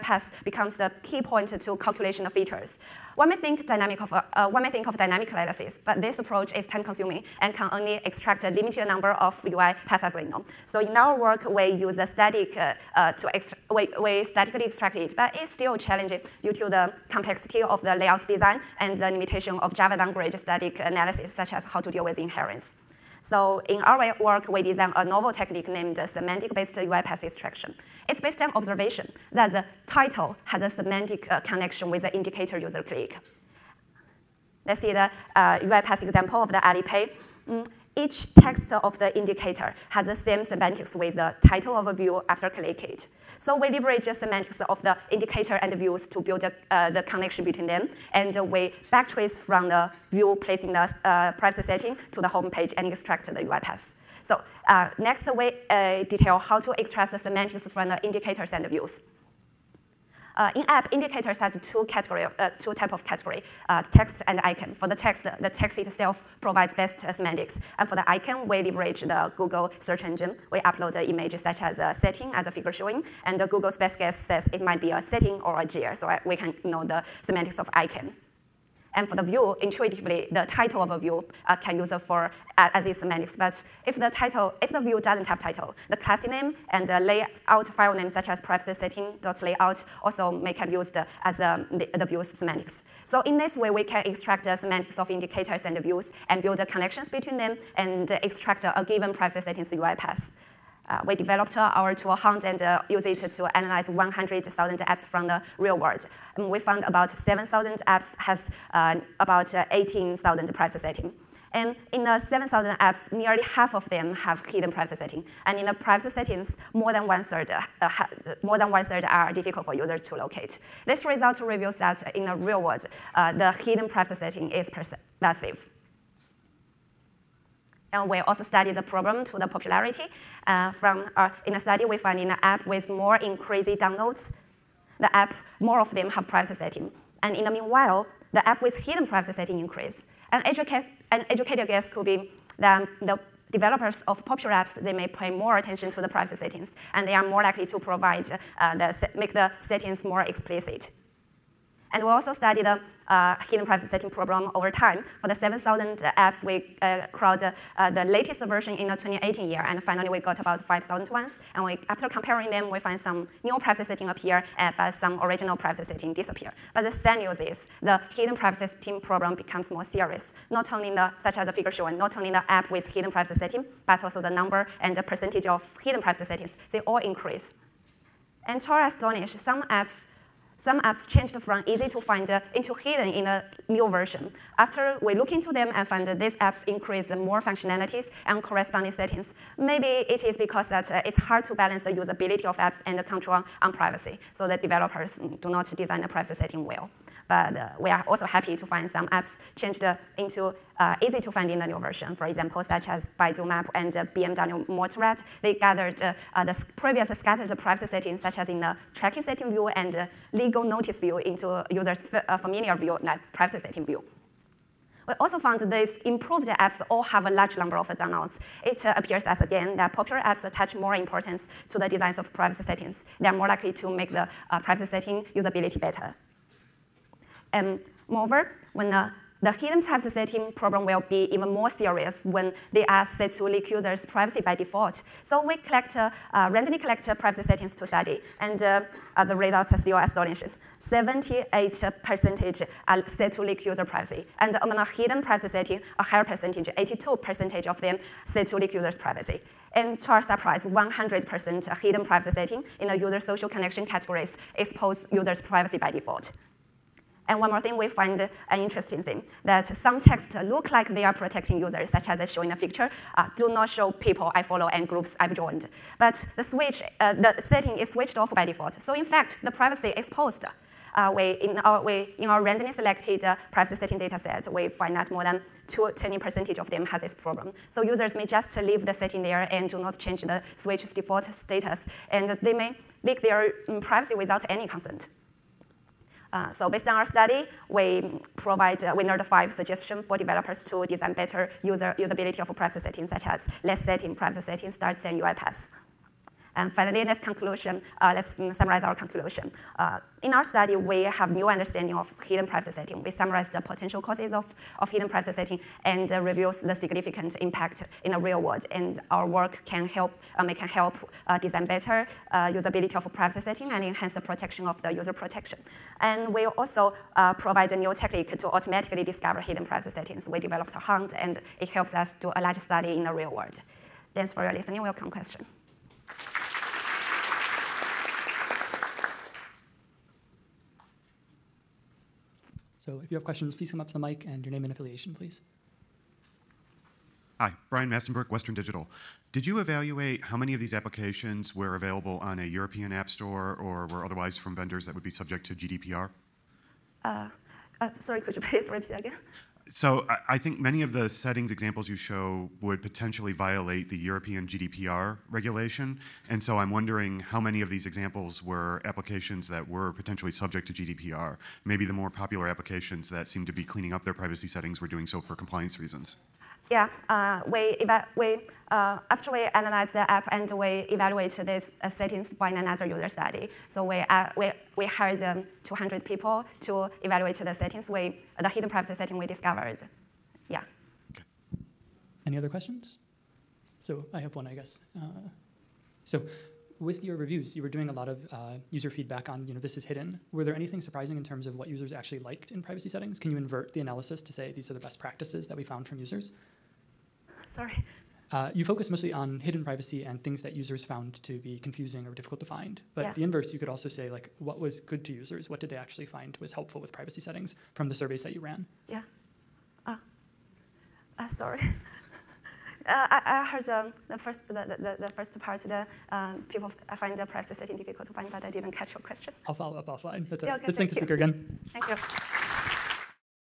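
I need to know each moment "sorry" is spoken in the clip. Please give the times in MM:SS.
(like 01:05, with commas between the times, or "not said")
05:47, 06:37, 06:51.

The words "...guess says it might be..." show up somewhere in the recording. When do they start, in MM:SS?
01:13.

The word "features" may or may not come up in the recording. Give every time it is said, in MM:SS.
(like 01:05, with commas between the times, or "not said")
00:02.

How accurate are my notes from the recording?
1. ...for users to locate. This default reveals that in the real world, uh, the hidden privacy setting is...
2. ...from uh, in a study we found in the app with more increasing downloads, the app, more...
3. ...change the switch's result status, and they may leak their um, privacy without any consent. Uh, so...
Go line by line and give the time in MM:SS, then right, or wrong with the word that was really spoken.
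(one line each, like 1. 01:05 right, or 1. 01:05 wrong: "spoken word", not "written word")
1. 01:59 wrong: "result", not "default"
2. 02:10 right
3. 04:39 wrong: "default", not "result".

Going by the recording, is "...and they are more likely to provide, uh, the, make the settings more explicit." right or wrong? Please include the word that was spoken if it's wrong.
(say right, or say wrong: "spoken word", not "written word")
right.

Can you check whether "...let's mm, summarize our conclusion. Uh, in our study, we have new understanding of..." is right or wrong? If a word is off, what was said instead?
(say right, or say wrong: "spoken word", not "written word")
right.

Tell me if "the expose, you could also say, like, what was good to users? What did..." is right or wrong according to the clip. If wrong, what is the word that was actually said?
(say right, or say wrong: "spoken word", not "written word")
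wrong: "inverse", not "expose".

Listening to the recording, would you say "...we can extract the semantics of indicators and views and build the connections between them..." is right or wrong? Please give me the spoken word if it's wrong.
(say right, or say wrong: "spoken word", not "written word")
right.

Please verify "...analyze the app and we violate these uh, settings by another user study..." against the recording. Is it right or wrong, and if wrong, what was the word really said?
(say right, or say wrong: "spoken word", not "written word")
wrong: "evaluate", not "violate".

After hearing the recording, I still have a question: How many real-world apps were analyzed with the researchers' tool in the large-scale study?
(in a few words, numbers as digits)
100,000.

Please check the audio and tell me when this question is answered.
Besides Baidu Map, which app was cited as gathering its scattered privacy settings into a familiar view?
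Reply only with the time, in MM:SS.
03:24.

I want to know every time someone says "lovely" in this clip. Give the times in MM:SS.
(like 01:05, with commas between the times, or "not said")
not said.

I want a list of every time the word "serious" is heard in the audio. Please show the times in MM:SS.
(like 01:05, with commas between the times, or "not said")
02:49, 03:51.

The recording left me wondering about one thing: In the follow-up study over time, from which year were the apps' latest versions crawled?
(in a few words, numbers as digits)
2018.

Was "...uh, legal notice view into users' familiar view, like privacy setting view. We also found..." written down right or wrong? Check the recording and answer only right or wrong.
right.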